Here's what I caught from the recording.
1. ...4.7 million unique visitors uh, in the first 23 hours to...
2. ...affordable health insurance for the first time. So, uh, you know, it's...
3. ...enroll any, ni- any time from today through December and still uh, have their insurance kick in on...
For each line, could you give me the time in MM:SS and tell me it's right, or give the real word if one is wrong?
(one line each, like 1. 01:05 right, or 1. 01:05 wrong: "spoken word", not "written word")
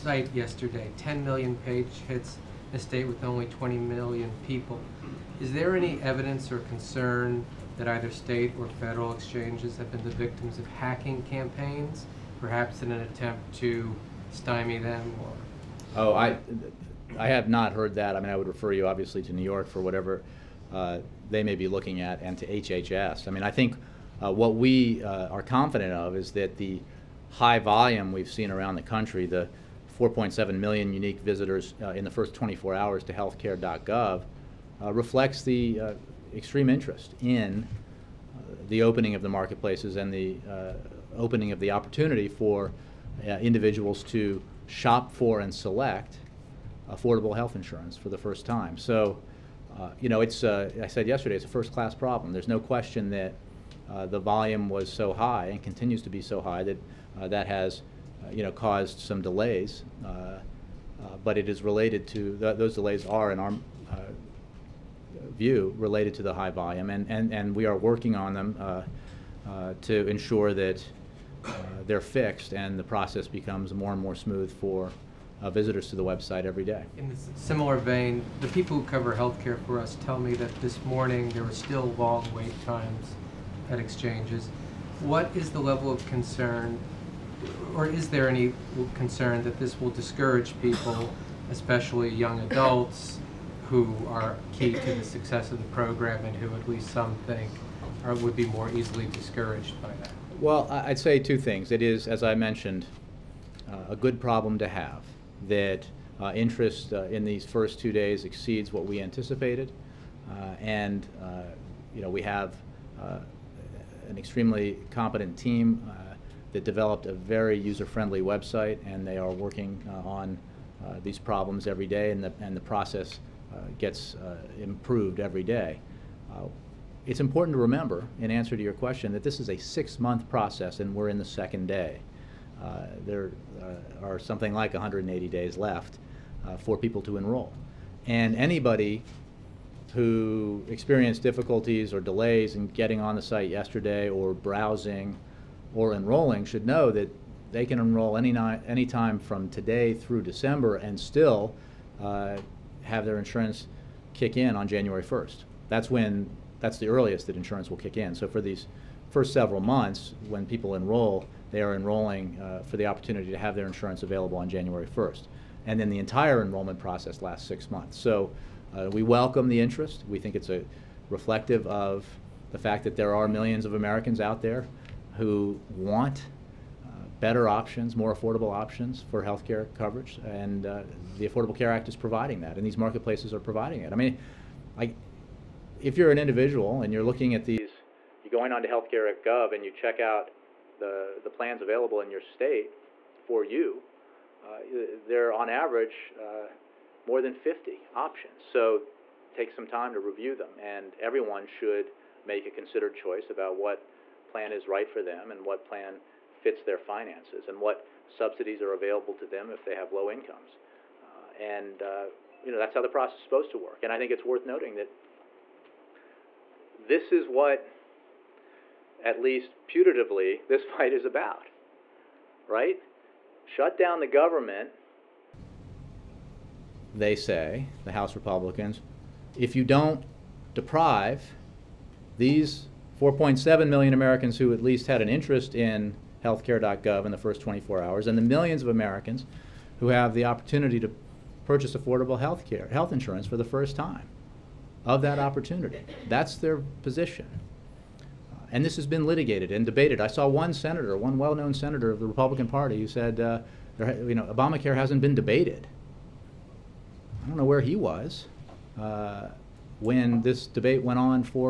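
1. 00:29 wrong: "24", not "23"
2. 00:46 right
3. 02:27 right.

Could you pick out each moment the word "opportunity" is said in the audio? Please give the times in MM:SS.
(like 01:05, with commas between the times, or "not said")
00:41, 02:42, 04:00, 04:05.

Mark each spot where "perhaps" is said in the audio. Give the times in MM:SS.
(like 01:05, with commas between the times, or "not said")
00:12.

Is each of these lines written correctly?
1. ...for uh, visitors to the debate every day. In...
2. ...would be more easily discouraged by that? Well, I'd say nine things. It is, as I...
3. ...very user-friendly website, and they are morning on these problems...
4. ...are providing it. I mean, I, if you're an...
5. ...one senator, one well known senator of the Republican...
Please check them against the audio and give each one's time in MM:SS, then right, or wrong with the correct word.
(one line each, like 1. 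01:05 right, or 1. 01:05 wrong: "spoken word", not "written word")
1. 01:14 wrong: "website", not "debate"
2. 01:38 wrong: "two", not "nine"
3. 01:57 wrong: "working", not "morning"
4. 03:03 right
5. 04:10 right.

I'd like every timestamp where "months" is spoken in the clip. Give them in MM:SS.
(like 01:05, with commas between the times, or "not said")
02:09, 02:39, 02:47.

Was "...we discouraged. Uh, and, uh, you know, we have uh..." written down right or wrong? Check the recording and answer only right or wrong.
wrong.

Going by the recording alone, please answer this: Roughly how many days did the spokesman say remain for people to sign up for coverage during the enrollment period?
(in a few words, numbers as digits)
180.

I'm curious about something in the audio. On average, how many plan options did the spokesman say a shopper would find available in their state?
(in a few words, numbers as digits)
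more than 50.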